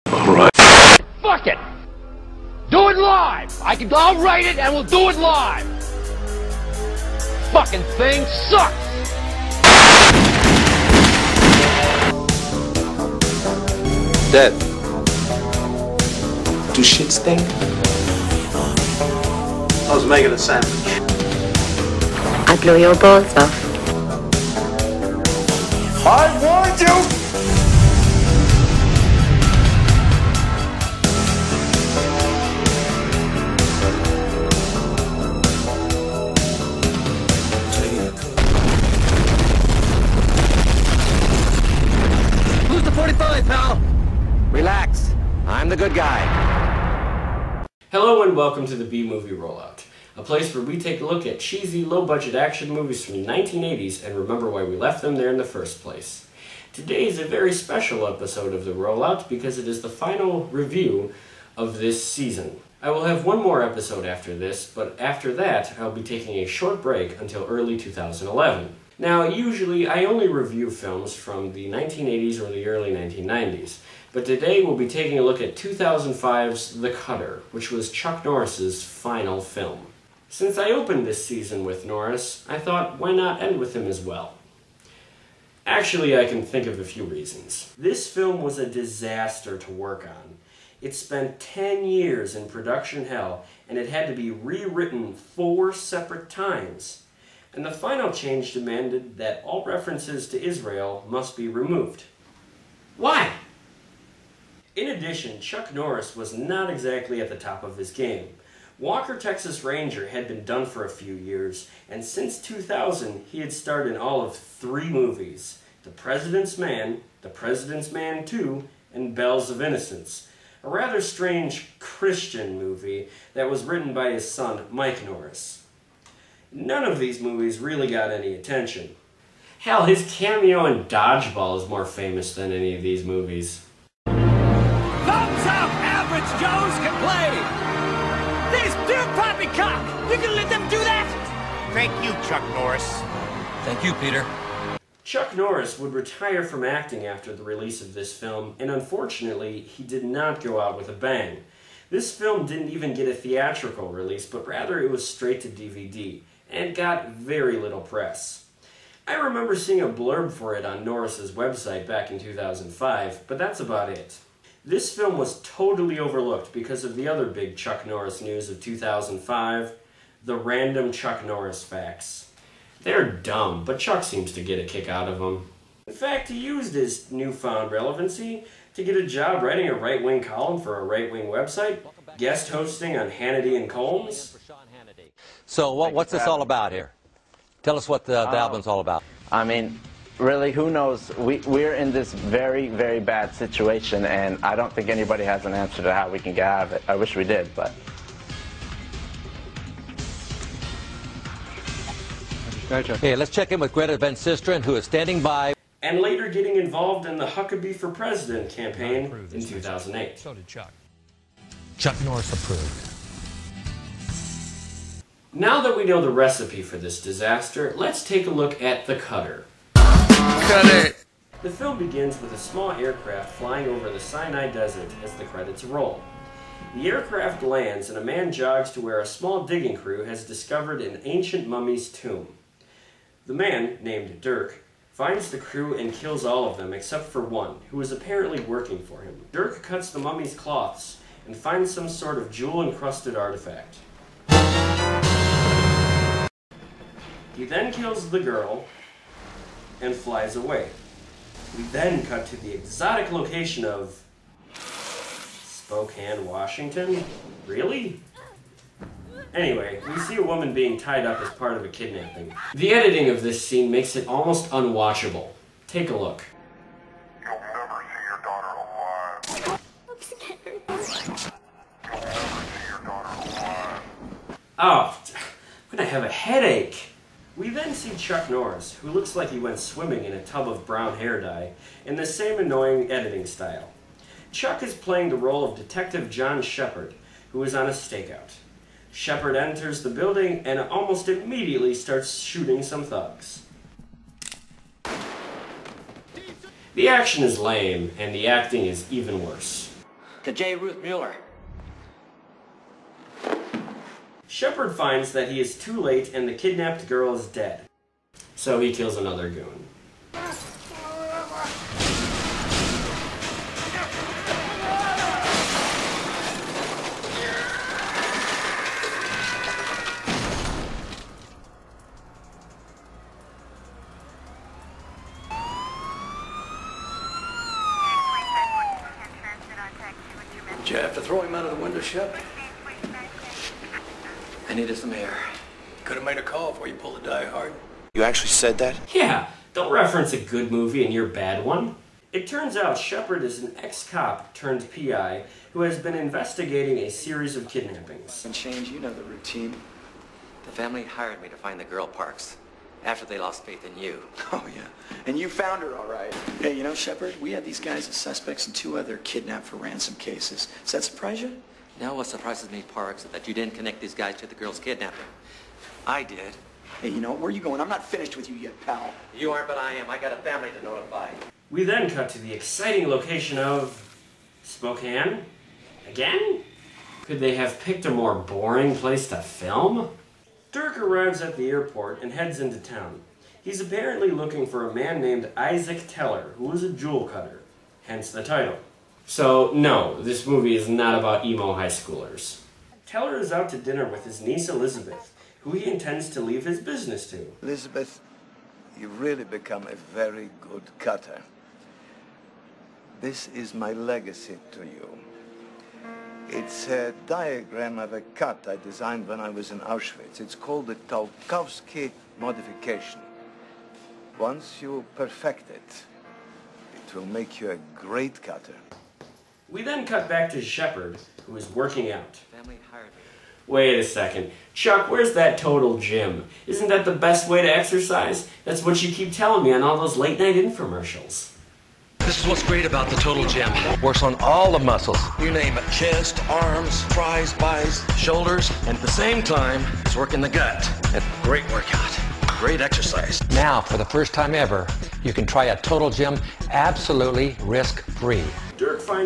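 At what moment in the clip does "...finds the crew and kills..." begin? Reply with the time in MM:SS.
03:54.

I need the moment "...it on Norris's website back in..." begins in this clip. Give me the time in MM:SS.
02:40.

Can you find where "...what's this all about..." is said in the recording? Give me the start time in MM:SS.
03:05.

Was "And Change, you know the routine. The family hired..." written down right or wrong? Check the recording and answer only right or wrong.
right.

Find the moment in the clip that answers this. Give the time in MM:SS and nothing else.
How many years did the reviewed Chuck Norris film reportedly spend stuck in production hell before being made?
01:31.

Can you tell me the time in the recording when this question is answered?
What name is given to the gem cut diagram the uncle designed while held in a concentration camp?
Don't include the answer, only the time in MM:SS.
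06:50.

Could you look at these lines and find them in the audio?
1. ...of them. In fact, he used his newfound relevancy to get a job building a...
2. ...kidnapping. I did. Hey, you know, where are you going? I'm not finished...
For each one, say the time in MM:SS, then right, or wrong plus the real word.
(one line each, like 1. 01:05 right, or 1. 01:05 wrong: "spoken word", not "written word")
1. 02:55 wrong: "writing", not "building"
2. 06:04 right.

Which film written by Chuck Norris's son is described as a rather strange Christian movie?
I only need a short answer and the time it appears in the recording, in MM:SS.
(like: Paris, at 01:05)
Bells of Innocence, at 01:59.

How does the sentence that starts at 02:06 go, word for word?
None of these movies really got any attention.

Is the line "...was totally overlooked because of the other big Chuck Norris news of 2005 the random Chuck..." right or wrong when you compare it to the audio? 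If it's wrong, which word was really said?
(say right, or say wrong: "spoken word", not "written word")
right.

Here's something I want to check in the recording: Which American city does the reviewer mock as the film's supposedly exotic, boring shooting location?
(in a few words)
Spokane, Washington.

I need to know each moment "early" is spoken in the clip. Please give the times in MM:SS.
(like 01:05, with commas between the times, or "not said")
01:07, 01:12.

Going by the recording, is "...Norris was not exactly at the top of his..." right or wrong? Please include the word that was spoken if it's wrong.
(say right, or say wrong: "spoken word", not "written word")
right.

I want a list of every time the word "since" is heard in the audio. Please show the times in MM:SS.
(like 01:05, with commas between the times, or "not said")
01:20, 01:52.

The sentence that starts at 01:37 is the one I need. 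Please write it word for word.
And the final change demanded that all references to Israel must be removed.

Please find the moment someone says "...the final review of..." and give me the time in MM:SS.
00:59.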